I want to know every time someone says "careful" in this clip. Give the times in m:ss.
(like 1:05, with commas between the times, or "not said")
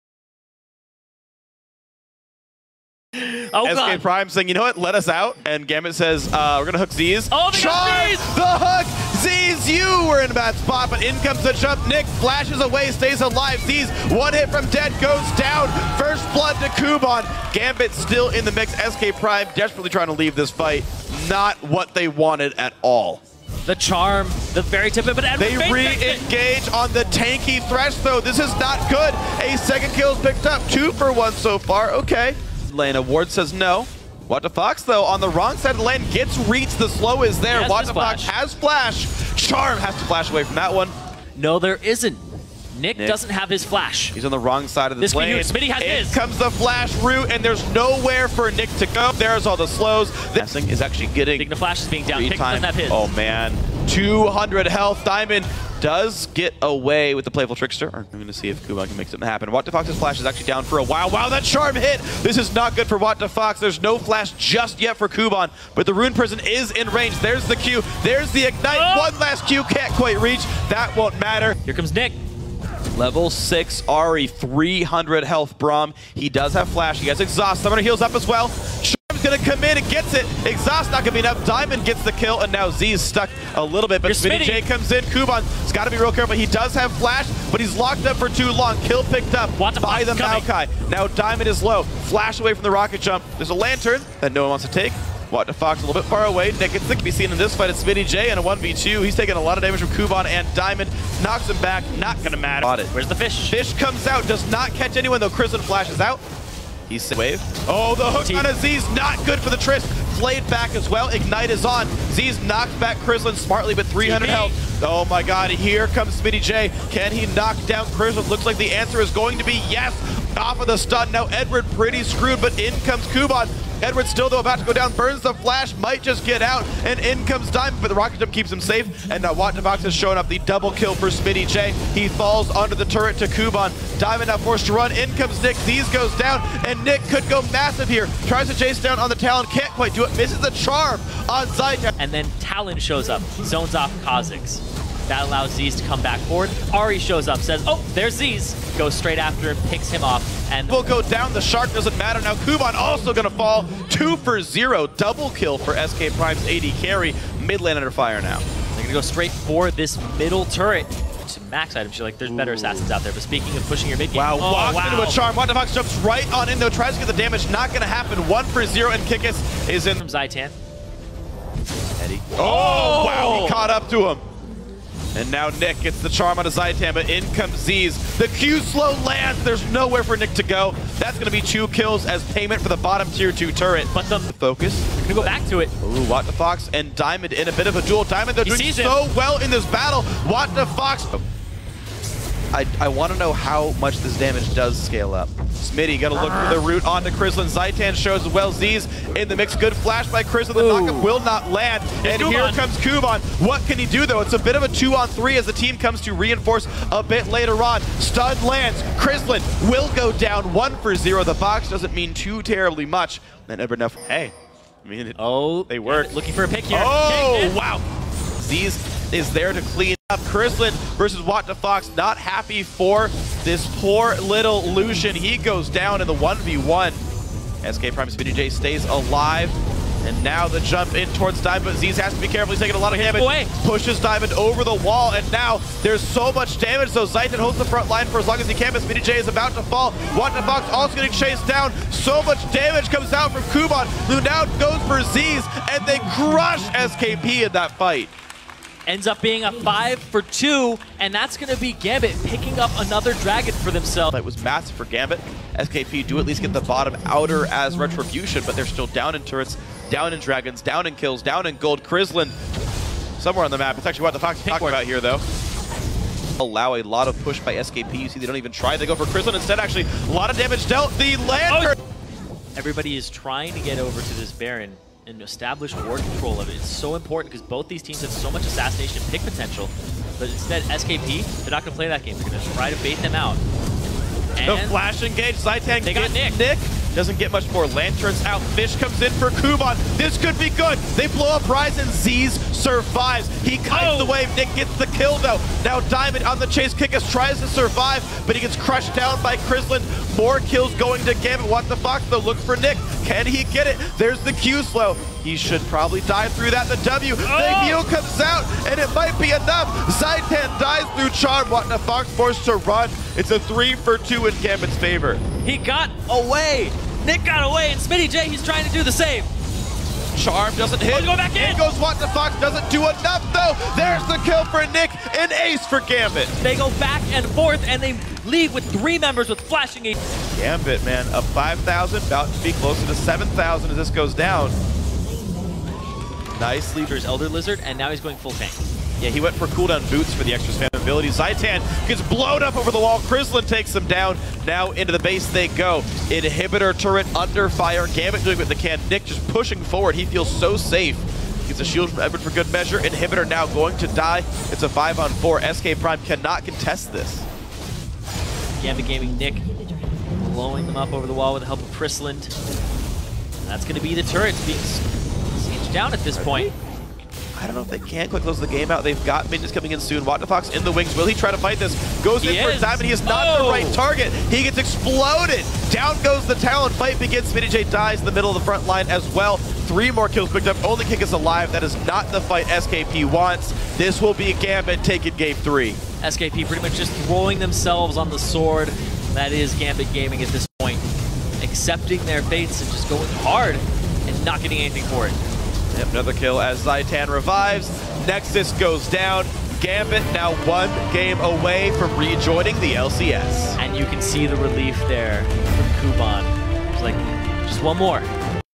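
1:26, 3:52.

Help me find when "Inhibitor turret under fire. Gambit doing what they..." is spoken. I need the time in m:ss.
5:46.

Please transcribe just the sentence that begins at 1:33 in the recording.
There's a Lantern that no one wants to take.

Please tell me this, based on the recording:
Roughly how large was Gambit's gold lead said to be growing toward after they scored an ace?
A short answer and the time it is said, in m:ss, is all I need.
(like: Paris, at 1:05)
7,000, at 5:32.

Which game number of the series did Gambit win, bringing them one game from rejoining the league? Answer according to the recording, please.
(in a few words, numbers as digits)
game 3.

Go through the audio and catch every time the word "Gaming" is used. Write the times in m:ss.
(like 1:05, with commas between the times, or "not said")
5:58, 6:29.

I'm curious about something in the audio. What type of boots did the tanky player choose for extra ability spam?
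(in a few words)
cooldown boots.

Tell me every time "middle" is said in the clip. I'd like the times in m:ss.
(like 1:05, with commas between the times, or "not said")
2:40, 6:18.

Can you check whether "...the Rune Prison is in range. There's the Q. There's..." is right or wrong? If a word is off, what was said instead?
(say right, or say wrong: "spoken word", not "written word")
right.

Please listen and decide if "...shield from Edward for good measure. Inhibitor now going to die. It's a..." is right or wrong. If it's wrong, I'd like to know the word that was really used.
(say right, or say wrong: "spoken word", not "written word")
right.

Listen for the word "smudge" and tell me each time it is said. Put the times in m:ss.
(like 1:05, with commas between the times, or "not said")
not said.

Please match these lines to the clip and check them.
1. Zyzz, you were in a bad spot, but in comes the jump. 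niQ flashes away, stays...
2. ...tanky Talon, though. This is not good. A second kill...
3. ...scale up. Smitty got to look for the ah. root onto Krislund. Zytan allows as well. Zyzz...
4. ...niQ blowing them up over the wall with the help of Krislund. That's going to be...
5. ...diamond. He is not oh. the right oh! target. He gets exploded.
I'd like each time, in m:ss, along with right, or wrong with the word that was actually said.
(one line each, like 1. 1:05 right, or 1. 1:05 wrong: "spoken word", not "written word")
1. 0:09 right
2. 0:27 wrong: "Thresh", not "Talon"
3. 3:14 wrong: "shows", not "allows"
4. 5:59 right
5. 6:12 right.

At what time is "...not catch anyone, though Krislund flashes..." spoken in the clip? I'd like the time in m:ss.
1:44.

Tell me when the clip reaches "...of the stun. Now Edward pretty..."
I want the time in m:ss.
2:00.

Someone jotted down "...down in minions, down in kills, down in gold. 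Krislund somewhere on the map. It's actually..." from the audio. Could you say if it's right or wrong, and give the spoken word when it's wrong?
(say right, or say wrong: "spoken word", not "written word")
wrong: "dragons", not "minions".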